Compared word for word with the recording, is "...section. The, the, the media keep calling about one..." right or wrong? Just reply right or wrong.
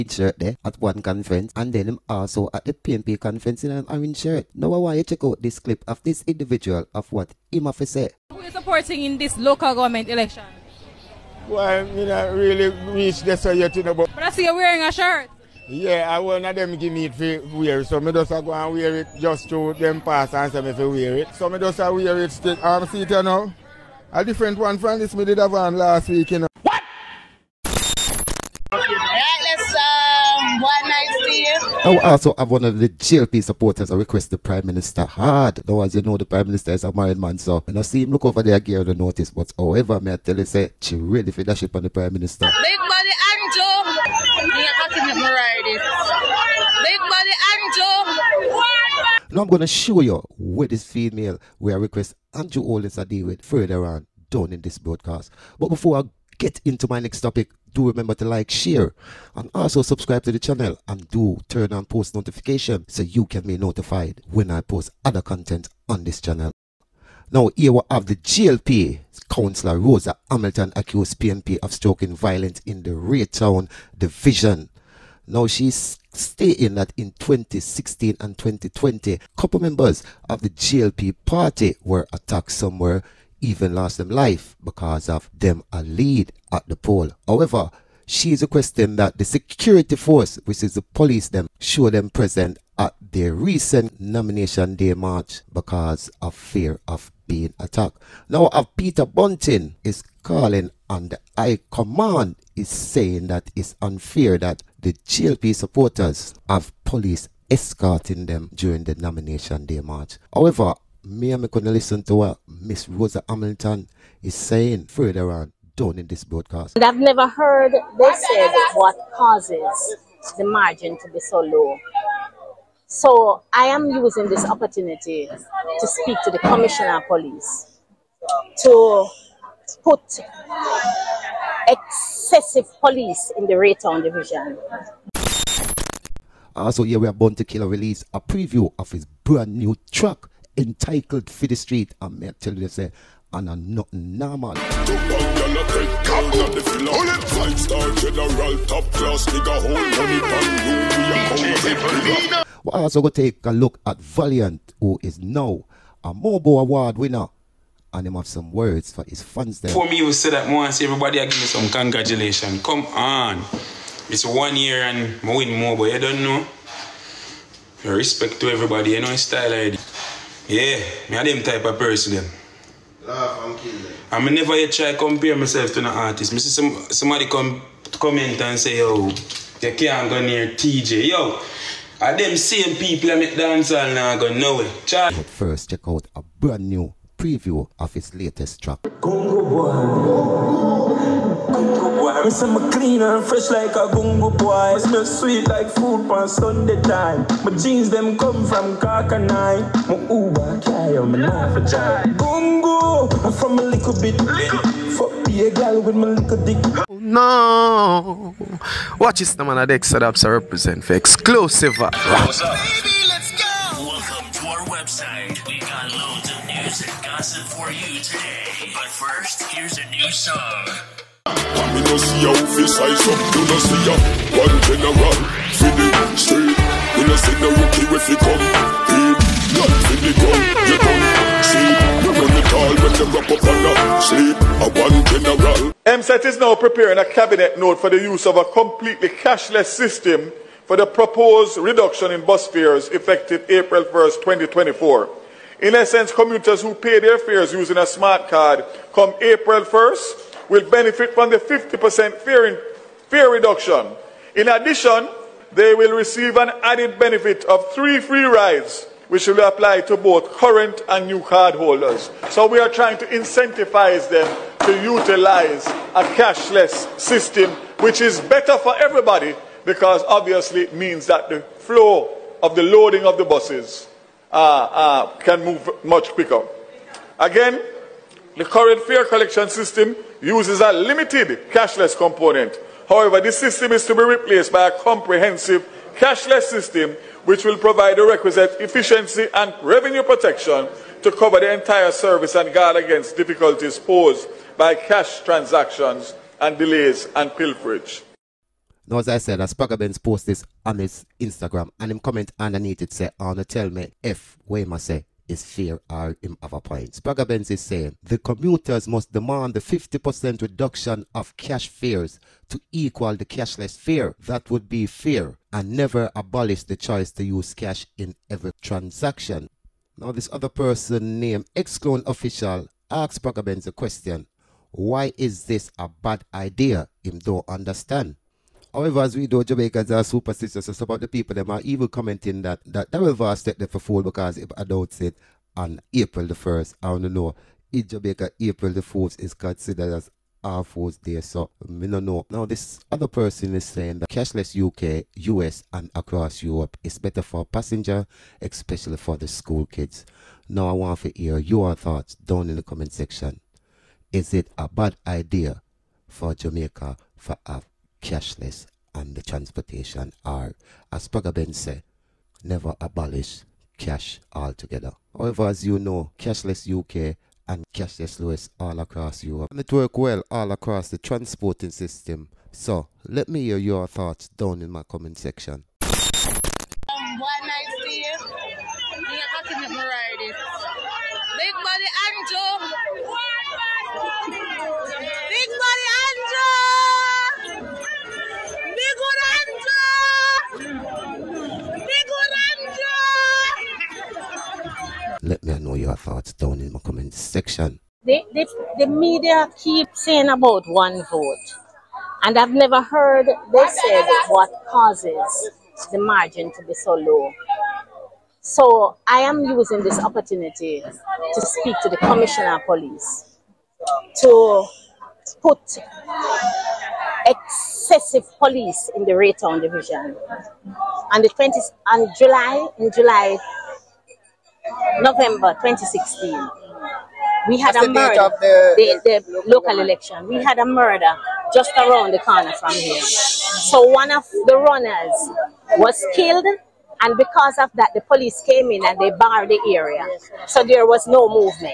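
wrong.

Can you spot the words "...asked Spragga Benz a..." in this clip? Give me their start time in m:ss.
5:22.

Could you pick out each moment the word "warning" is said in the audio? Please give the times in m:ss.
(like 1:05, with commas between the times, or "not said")
not said.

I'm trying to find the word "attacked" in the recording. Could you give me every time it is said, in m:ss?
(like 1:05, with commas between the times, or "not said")
1:22, 1:37.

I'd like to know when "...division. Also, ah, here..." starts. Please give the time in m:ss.
2:14.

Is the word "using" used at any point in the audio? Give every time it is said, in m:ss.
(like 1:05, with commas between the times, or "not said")
2:03, 4:07, 6:49.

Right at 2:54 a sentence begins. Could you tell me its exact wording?
I me never yet try compare myself to an artist.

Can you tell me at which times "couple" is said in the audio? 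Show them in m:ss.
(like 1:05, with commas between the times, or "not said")
1:19.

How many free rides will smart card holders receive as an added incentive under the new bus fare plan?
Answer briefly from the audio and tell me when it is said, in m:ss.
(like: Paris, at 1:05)
3, at 4:17.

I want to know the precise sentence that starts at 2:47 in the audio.
Respect to everybody, you know, style already.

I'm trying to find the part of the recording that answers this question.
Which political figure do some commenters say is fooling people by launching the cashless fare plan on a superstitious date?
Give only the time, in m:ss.
5:32.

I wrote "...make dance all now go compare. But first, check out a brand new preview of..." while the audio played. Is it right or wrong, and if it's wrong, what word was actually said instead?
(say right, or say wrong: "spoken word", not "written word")
wrong: "nowhere", not "compare".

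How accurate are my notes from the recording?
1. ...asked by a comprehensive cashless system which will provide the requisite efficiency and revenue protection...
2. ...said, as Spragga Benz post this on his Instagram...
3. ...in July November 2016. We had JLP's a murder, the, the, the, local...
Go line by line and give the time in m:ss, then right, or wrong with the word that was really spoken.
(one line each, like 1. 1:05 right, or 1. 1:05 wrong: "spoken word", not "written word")
1. 4:44 wrong: "replaced", not "asked"
2. 4:59 right
3. 7:02 wrong: "That", not "JLP".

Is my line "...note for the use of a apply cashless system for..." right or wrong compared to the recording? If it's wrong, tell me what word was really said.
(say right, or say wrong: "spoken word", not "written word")
wrong: "completely", not "apply".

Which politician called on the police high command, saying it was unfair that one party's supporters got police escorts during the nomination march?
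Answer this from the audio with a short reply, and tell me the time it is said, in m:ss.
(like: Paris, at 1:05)
Peter Bunting, at 1:38.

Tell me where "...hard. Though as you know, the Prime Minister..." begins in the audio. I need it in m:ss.
0:35.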